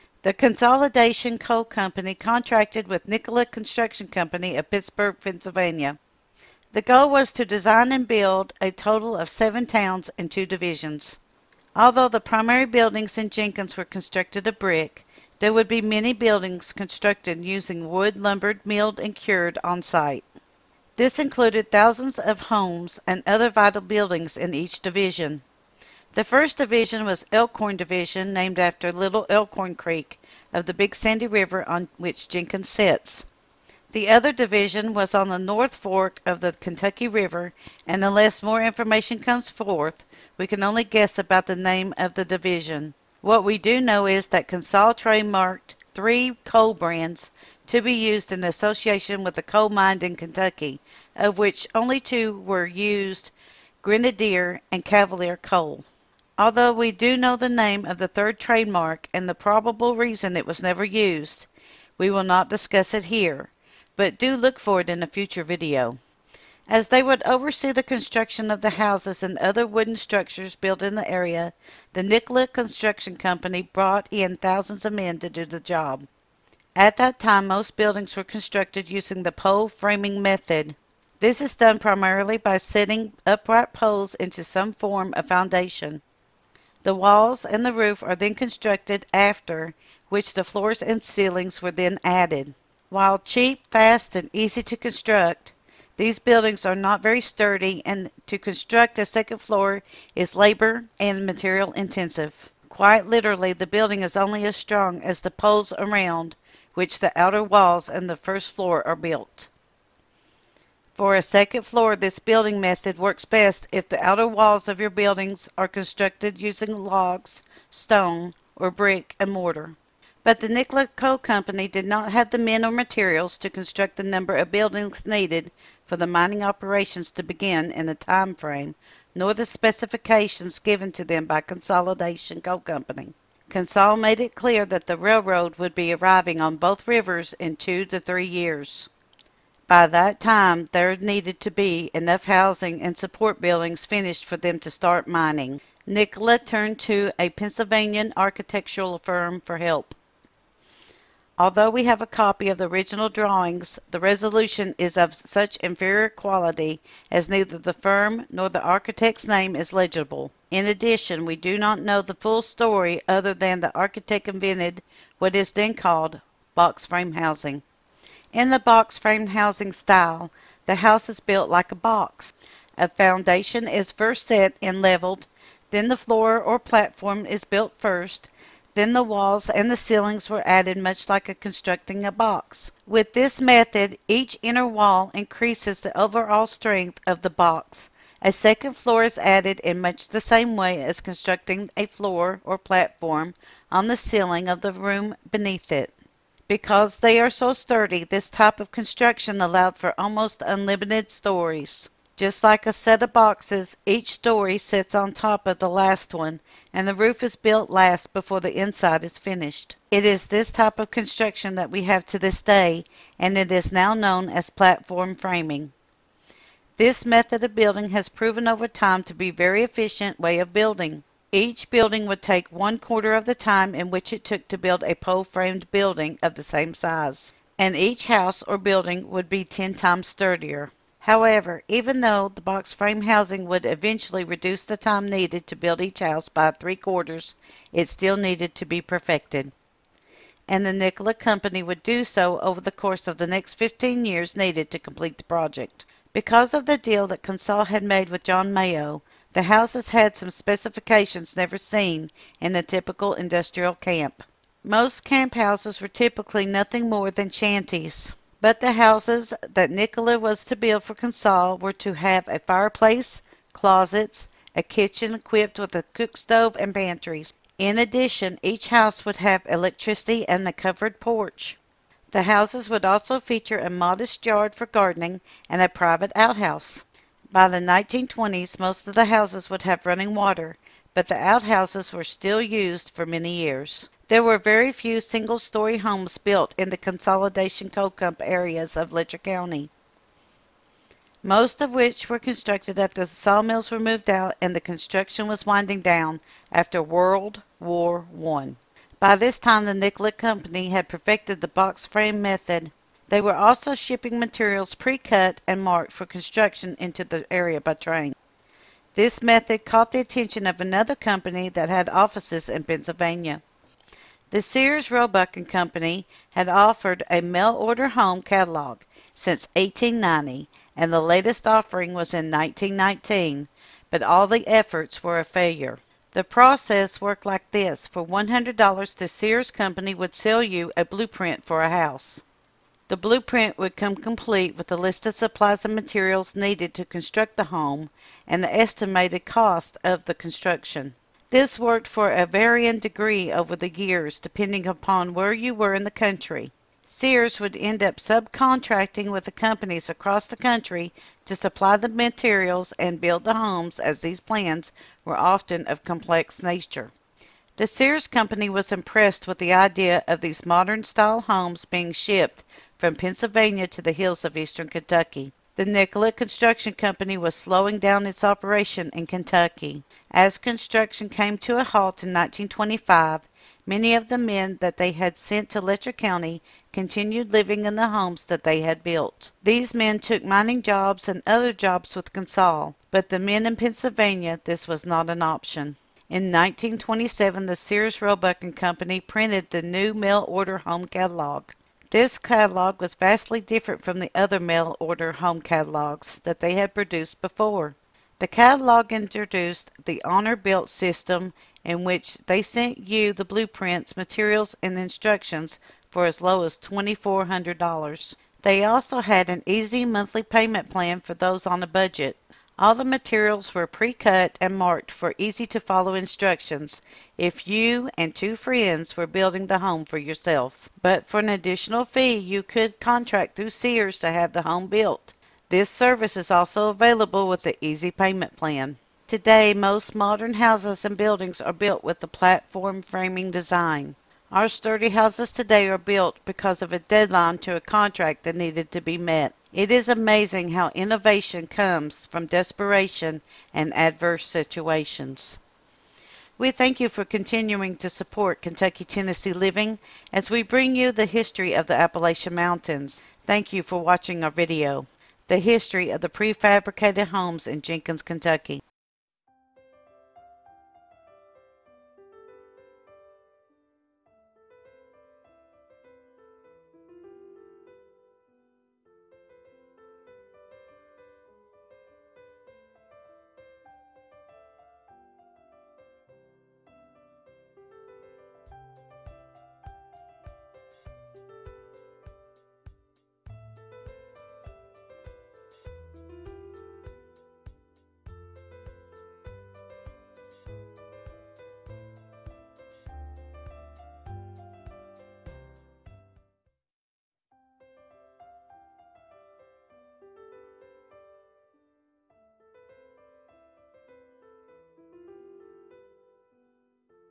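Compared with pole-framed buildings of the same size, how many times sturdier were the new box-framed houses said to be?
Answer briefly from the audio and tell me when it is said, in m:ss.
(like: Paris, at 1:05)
10, at 3:49.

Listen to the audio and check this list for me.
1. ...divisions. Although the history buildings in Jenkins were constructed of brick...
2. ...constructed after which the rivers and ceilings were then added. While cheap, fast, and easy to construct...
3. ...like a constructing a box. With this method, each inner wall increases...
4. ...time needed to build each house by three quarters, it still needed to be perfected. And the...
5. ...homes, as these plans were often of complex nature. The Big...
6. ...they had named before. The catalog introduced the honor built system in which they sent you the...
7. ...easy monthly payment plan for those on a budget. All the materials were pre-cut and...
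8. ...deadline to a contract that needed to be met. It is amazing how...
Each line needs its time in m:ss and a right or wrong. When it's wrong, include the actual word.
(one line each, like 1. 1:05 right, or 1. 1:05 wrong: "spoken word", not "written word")
1. 0:10 wrong: "primary", not "history"
2. 1:28 wrong: "floors", not "rivers"
3. 3:01 right
4. 3:54 right
5. 5:53 wrong: "Sears", not "Big"
6. 6:36 wrong: "produced", not "named"
7. 6:49 right
8. 7:16 right.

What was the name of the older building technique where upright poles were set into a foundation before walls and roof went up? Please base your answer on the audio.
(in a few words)
pole framing.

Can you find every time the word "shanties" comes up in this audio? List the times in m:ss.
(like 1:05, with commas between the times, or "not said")
4:17.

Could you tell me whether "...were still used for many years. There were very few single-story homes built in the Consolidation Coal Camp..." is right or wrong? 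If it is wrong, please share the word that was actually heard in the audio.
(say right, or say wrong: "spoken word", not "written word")
right.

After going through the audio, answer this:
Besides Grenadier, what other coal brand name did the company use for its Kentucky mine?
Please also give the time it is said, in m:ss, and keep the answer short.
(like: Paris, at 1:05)
Cavalier, at 0:54.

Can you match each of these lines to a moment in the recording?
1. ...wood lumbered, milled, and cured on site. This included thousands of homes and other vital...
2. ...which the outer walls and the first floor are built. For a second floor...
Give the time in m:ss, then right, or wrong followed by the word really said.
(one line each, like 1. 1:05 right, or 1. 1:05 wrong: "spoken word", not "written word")
1. 0:17 right
2. 1:46 right.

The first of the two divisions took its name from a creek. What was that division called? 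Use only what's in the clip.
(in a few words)
Elkhorn Division.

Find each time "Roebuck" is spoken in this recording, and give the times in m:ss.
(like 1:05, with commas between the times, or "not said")
5:14, 6:28.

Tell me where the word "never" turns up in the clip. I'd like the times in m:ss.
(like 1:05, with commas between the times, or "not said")
1:00, 4:11.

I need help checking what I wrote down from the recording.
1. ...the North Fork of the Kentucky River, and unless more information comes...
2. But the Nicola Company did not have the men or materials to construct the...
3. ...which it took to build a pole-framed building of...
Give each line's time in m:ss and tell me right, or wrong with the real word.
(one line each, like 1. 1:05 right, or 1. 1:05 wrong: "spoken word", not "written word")
1. 0:35 right
2. 2:00 right
3. 3:43 right.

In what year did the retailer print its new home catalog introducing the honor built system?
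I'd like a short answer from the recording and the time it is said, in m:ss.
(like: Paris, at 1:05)
1927, at 6:26.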